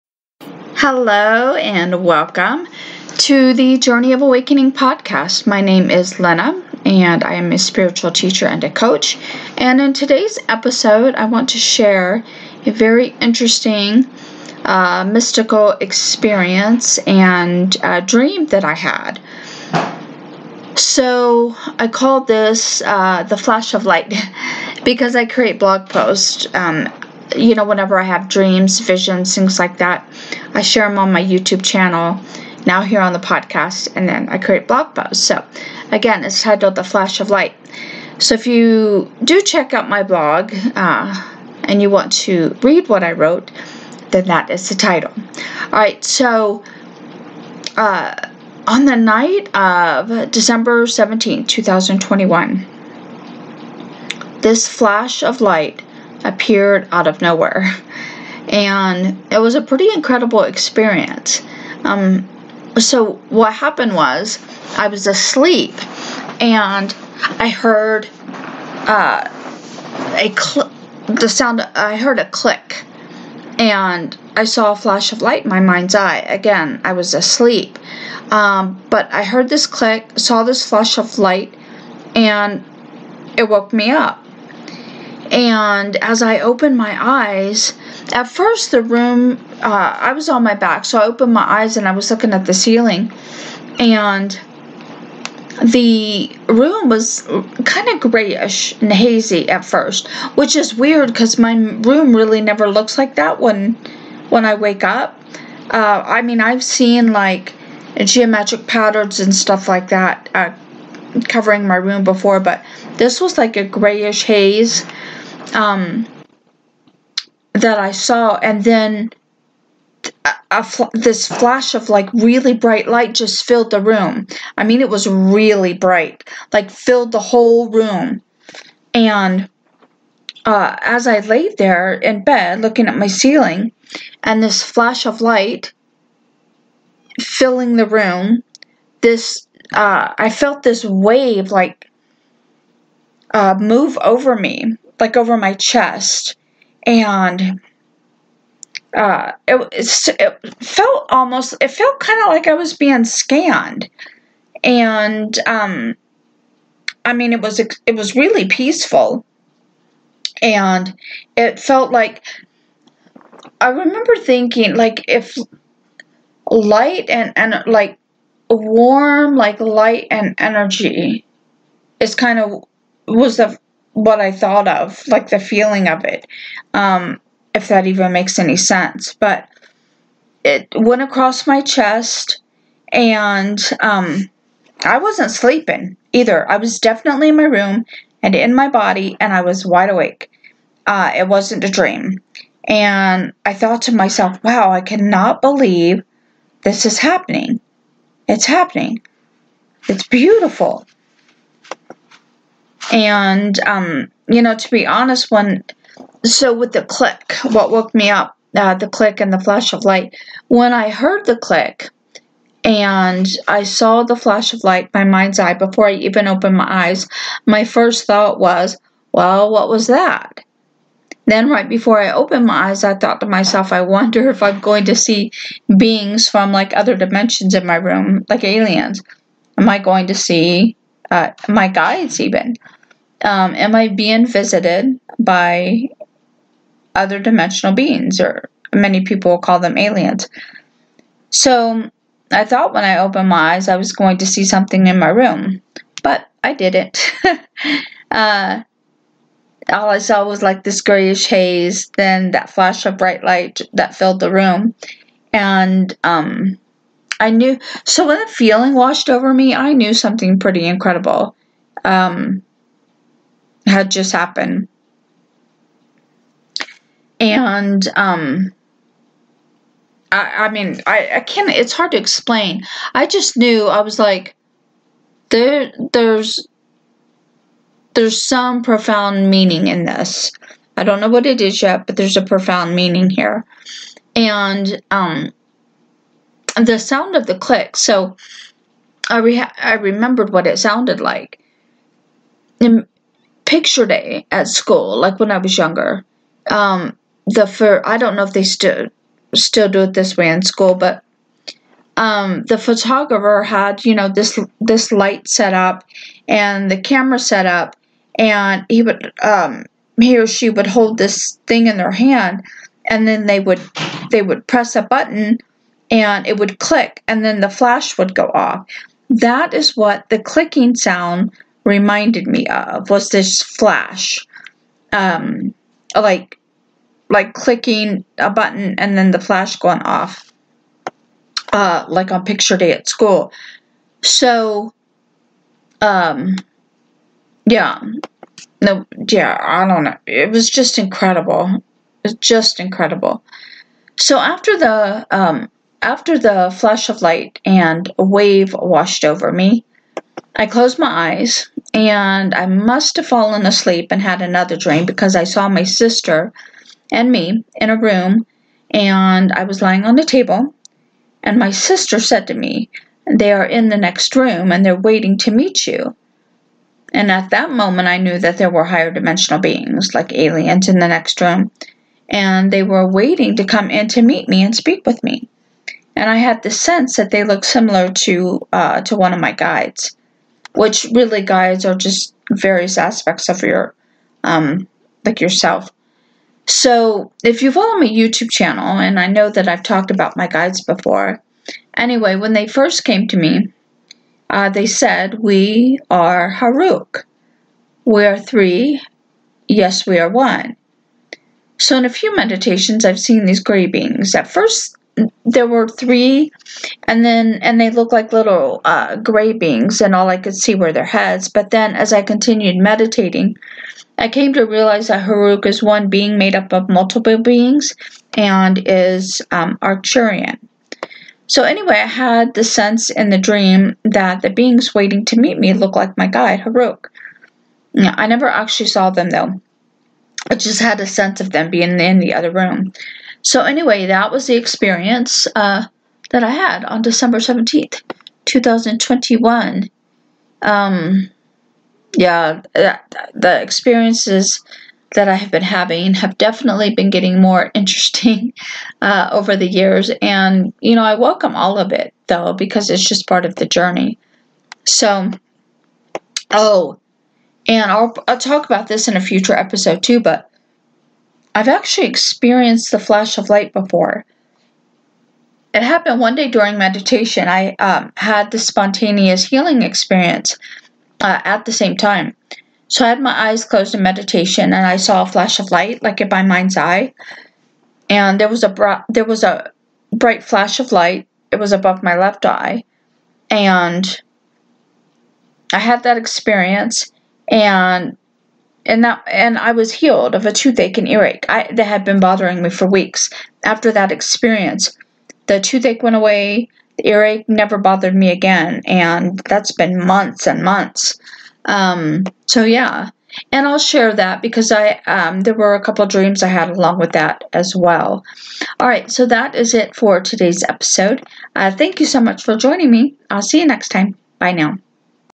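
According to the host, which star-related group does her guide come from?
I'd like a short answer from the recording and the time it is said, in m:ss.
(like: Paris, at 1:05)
Arcturian, at 6:59.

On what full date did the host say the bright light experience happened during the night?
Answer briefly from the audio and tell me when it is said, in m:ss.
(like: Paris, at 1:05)
December 17, 2021, at 0:50.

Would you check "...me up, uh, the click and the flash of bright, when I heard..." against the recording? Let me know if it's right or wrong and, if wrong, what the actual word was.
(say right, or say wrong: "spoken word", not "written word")
wrong: "light", not "bright".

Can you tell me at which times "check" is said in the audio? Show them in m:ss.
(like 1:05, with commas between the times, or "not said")
0:39.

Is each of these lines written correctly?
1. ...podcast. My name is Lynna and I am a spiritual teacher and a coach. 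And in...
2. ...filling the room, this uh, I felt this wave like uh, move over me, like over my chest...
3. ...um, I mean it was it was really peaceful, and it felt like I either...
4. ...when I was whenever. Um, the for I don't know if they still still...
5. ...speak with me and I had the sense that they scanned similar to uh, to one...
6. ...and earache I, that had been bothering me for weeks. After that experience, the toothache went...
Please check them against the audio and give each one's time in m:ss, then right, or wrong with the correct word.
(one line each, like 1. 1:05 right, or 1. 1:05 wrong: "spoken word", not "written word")
1. 0:04 right
2. 2:17 right
3. 2:35 wrong: "remember", not "either"
4. 4:55 wrong: "younger", not "whenever"
5. 6:14 wrong: "looked", not "scanned"
6. 8:10 right.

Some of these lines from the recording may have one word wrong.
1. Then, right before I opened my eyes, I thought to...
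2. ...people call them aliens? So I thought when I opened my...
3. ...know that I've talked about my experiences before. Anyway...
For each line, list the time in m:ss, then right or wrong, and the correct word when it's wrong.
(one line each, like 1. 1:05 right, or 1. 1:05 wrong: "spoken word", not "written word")
1. 3:41 right
2. 3:59 right
3. 6:29 wrong: "guides", not "experiences".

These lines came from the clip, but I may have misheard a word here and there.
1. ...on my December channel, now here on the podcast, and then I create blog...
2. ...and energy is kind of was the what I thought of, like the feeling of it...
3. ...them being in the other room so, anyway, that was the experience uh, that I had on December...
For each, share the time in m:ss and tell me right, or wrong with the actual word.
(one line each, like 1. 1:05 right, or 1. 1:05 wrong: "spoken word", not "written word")
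1. 0:30 wrong: "YouTube", not "December"
2. 2:50 right
3. 7:11 right.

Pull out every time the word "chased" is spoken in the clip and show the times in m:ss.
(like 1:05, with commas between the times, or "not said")
not said.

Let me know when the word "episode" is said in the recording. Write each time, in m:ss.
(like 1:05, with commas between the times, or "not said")
0:10, 7:39, 8:30.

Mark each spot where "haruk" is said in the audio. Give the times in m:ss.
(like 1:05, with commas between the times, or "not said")
6:36, 6:55, 7:06.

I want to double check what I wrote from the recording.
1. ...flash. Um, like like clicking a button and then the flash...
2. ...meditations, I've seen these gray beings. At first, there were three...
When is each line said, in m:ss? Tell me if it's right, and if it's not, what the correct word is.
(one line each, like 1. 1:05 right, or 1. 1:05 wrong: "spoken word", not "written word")
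1. 5:23 right
2. 6:42 right.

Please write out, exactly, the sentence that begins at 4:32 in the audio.
I just knew, I was like, there, there's, there's some profound meaning in this.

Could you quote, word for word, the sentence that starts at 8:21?
Um, so yeah, and I'll share that because I um, there were a couple dreams I had along with that as well.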